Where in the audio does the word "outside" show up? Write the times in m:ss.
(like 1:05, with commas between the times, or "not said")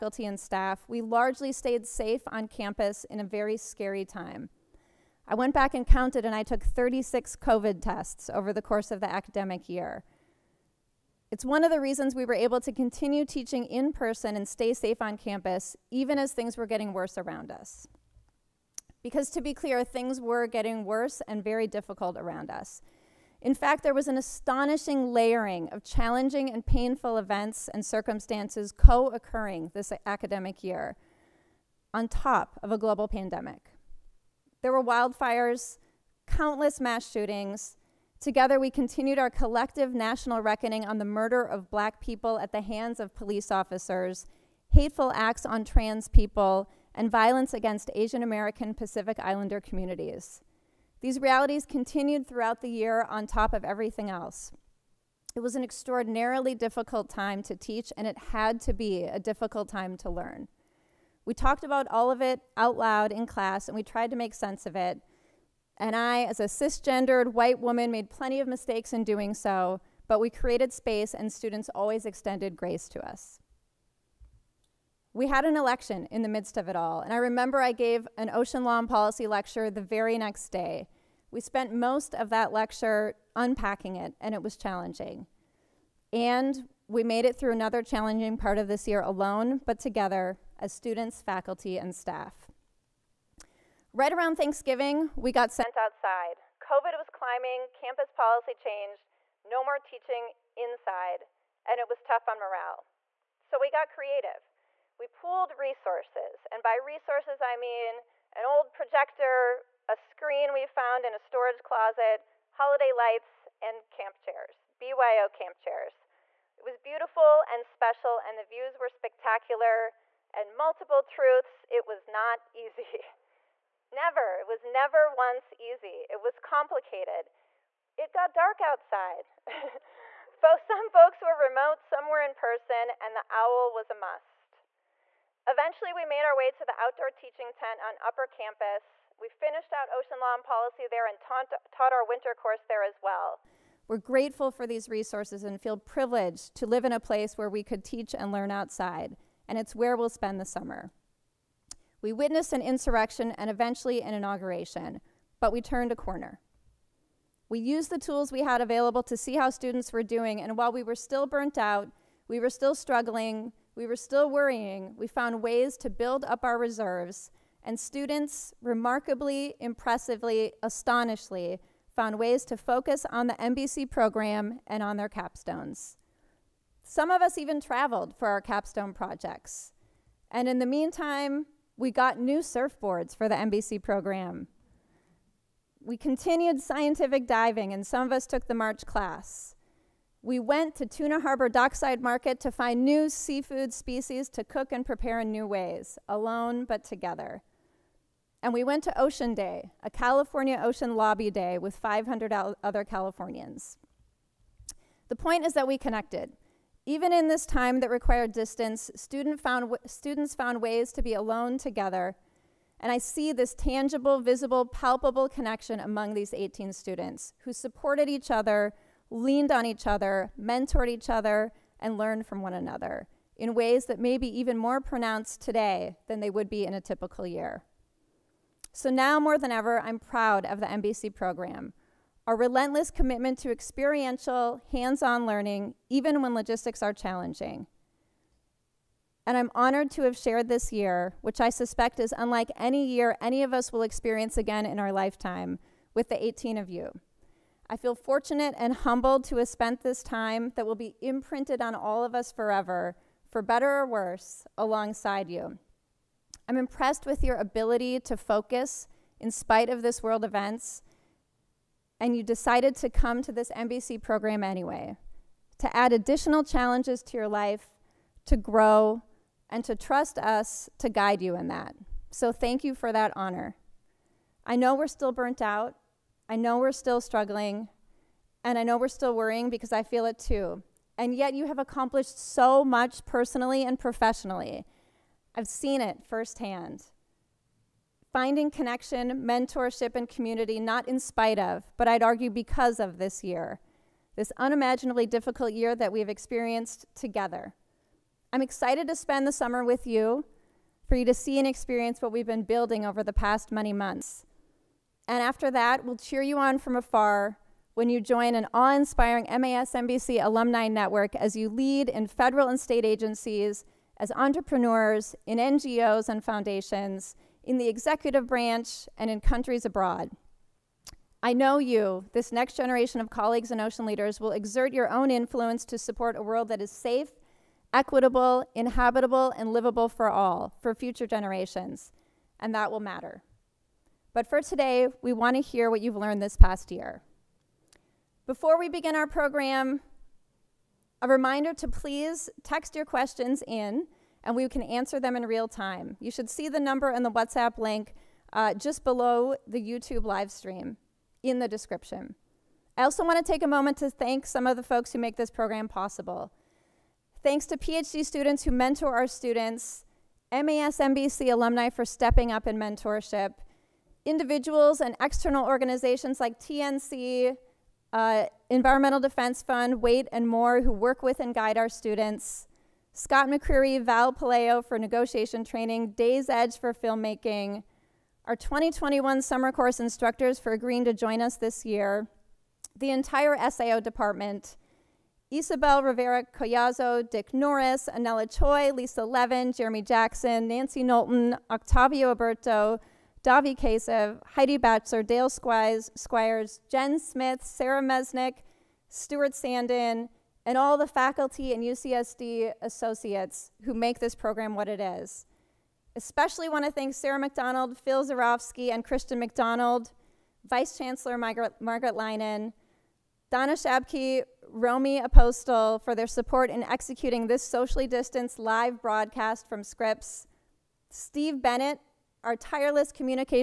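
1:35, 2:08, 2:28.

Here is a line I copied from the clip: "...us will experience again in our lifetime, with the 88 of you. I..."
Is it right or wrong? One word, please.
wrong.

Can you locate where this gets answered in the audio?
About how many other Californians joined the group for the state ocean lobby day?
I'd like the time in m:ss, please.
3:21.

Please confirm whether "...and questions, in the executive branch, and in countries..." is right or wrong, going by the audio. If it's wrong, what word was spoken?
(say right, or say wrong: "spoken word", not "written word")
wrong: "foundations", not "questions".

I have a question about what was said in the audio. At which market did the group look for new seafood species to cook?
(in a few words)
Tuna Harbor Dockside Market.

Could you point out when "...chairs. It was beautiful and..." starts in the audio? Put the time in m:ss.
1:55.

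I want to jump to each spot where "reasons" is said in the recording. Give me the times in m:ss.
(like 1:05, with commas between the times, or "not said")
0:11.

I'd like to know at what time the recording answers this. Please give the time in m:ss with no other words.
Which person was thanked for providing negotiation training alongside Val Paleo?
6:12.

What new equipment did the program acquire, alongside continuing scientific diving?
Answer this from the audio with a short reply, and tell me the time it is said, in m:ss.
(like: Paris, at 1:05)
Surfboards, at 3:02.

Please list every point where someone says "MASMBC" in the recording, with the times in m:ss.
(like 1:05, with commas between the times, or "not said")
5:09, 6:00.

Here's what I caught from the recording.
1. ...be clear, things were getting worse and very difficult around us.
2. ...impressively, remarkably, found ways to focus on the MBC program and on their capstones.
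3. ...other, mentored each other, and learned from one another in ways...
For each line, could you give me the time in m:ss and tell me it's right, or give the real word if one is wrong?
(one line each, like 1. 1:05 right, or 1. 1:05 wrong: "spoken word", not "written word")
1. 0:19 right
2. 2:49 wrong: "astonishingly", not "remarkably"
3. 3:39 right.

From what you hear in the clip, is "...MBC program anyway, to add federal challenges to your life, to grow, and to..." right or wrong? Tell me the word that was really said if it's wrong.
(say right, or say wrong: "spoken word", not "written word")
wrong: "additional", not "federal".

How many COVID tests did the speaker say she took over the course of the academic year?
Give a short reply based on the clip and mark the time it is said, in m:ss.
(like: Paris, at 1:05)
36, at 0:06.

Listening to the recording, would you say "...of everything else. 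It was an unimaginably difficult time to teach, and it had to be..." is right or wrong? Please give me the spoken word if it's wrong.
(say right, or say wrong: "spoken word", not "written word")
wrong: "extraordinarily", not "unimaginably".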